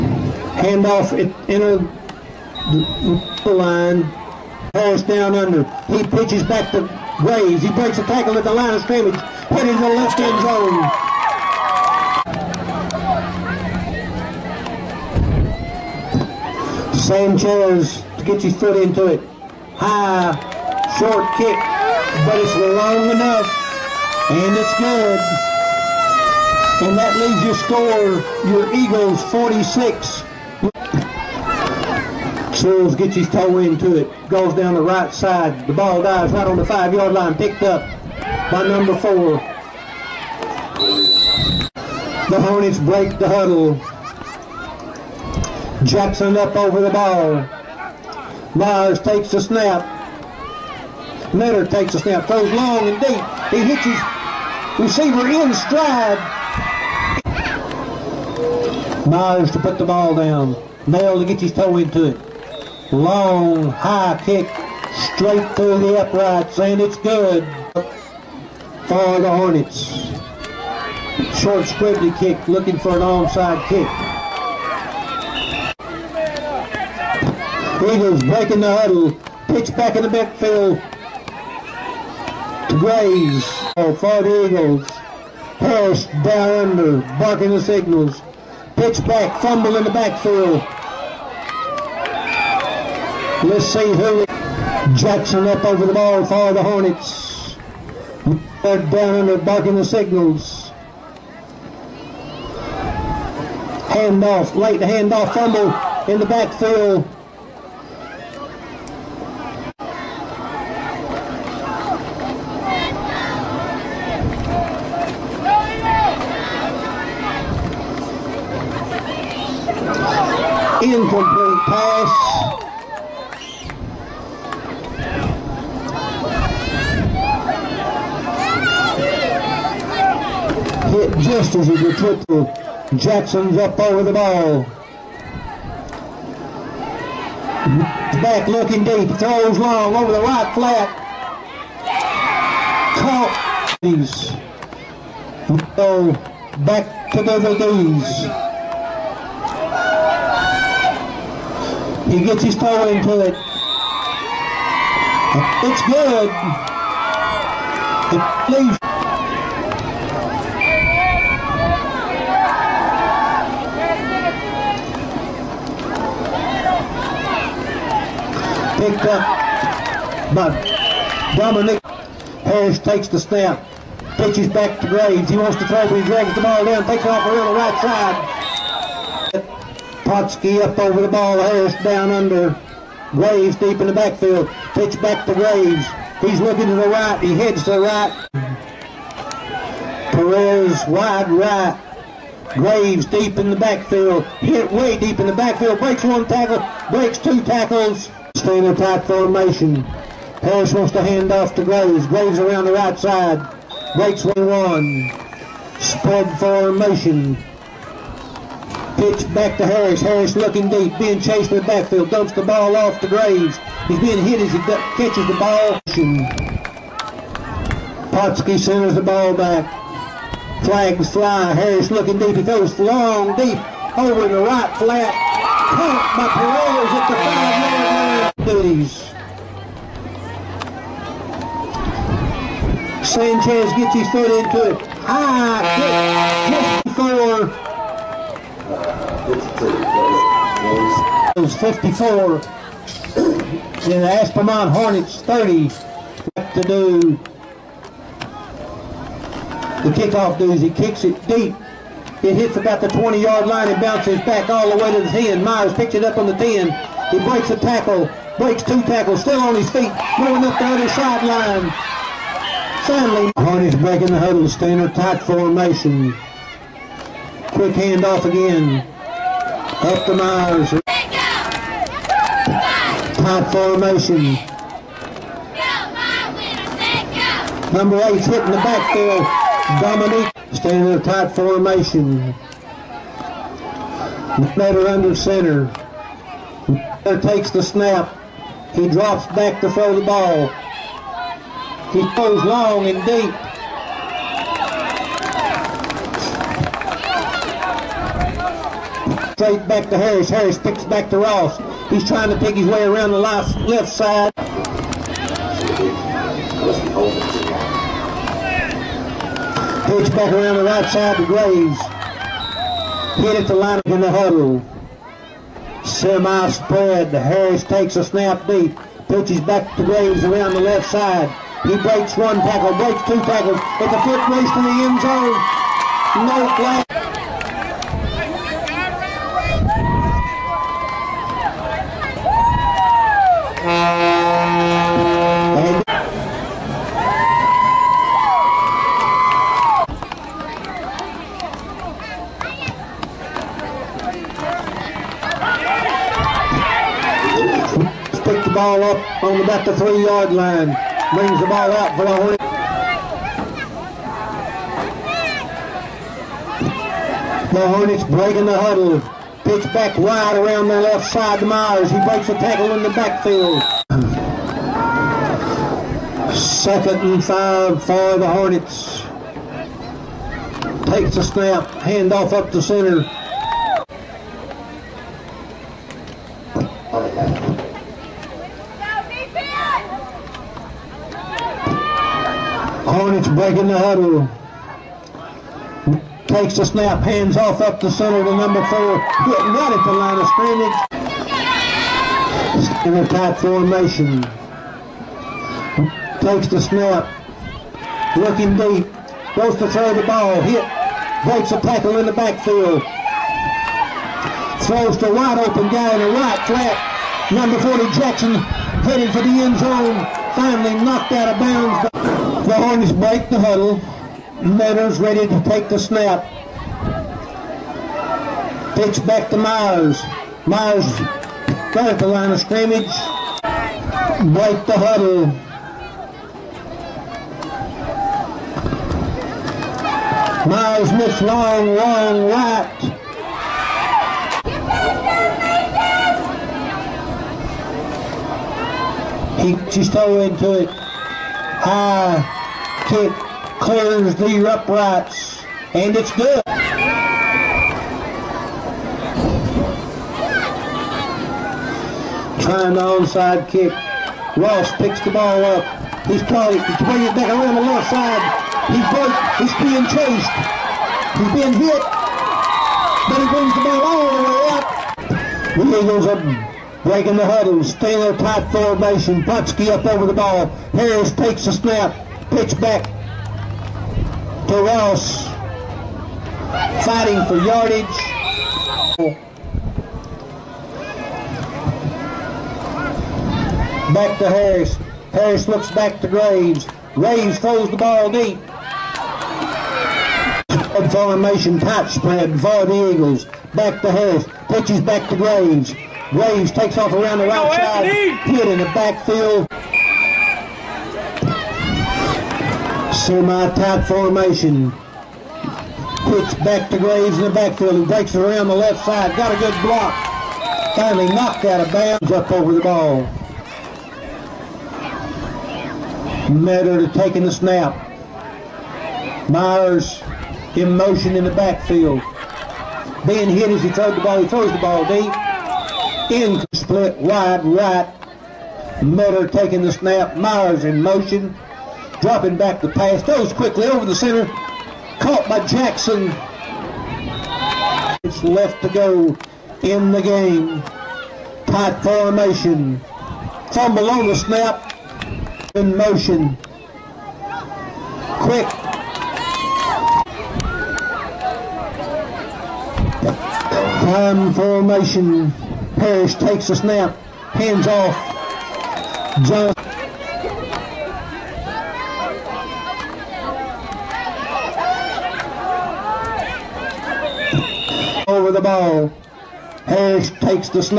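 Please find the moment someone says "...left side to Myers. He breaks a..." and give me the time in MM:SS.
06:00.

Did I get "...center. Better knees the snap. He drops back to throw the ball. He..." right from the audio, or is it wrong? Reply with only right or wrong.
wrong.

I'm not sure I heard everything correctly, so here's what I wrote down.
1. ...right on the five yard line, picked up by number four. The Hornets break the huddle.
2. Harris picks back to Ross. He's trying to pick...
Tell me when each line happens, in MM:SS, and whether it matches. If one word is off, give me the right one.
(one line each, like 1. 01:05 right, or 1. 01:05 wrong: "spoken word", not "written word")
1. 00:36 right
2. 05:00 right.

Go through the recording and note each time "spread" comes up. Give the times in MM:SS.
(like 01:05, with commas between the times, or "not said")
03:25, 05:16, 08:11.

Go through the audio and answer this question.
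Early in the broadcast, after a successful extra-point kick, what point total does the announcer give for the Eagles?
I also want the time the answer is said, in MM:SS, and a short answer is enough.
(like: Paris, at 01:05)
46, at 00:28.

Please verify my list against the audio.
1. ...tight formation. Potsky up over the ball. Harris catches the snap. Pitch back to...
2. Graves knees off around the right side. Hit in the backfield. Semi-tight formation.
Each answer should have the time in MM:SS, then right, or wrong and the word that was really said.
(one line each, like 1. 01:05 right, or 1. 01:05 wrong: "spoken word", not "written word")
1. 07:48 wrong: "takes", not "catches"
2. 08:16 wrong: "takes", not "knees".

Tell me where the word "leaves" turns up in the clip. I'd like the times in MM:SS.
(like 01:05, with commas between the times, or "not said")
00:27, 02:38.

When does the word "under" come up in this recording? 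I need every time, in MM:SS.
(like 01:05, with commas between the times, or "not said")
00:05, 01:26, 03:02, 04:44.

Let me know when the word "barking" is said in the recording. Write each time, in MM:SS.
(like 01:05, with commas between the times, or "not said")
01:27, 01:39.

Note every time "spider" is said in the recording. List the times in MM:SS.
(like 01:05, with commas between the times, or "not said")
not said.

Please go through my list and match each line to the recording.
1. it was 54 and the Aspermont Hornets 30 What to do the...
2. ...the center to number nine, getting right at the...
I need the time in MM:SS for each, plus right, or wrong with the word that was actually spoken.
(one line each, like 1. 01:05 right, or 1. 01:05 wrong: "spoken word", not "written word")
1. 04:01 right
2. 06:27 wrong: "four", not "nine".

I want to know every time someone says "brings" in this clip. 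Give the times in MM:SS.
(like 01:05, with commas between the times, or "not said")
05:51, 07:36, 07:43.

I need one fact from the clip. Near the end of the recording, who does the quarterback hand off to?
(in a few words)
Johnson.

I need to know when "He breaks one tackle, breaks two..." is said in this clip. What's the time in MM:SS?
05:21.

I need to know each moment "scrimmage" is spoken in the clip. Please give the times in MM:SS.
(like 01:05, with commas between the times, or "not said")
00:08, 06:30, 07:02.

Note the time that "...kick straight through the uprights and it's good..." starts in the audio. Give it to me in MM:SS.
01:04.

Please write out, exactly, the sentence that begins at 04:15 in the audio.
Myers picks it up on the 10.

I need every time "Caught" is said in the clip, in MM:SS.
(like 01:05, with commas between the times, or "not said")
02:22, 03:45, 08:54.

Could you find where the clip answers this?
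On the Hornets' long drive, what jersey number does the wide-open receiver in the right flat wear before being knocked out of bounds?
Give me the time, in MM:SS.
06:47.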